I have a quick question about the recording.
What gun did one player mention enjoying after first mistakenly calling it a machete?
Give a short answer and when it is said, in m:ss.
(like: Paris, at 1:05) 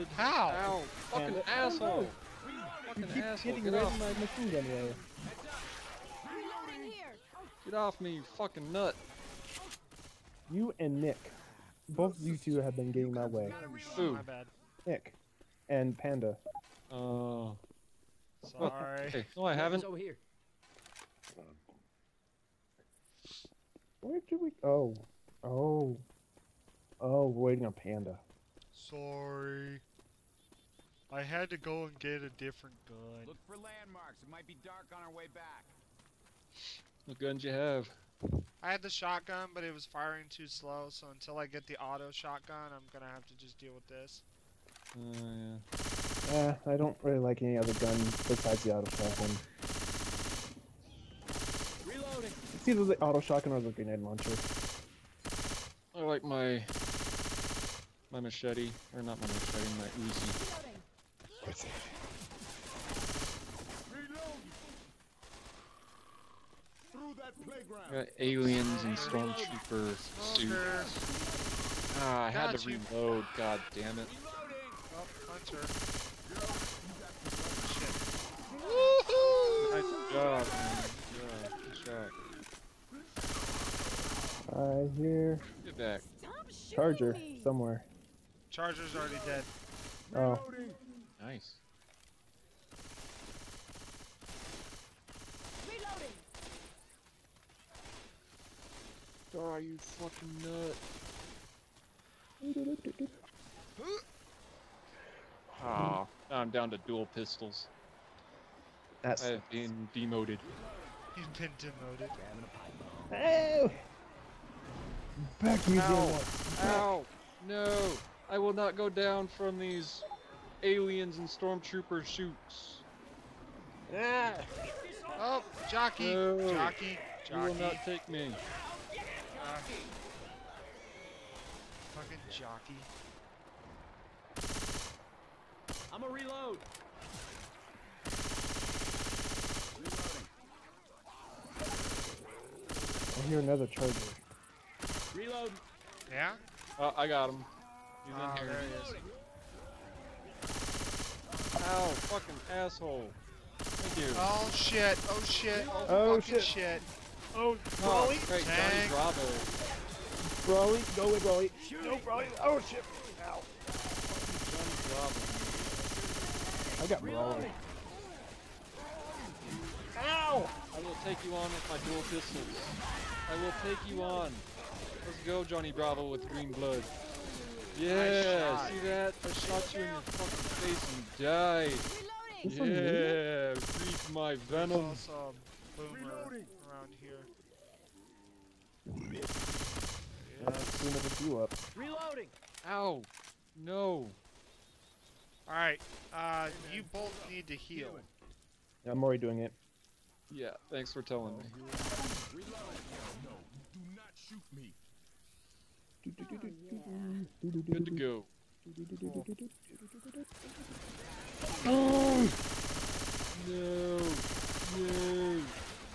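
Uzi, at 1:00.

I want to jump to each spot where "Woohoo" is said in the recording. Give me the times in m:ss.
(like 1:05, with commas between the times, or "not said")
1:18.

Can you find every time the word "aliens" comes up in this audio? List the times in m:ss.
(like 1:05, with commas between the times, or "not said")
1:08, 2:00.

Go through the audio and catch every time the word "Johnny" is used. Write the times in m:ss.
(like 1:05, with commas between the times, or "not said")
2:38, 2:44, 2:55.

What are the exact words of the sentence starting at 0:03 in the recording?
Getting Get off my machine gun way.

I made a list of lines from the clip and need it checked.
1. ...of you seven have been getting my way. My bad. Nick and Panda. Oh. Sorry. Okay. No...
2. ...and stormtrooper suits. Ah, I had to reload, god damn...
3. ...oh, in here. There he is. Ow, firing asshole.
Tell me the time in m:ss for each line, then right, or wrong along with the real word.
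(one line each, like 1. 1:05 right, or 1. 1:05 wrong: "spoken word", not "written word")
1. 0:12 wrong: "two", not "seven"
2. 1:08 right
3. 2:28 wrong: "fucking", not "firing".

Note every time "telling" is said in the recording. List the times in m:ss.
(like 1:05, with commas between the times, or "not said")
3:21.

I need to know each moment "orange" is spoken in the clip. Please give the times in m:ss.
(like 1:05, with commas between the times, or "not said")
not said.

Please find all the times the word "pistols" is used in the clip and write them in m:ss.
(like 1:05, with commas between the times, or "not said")
1:47, 2:52.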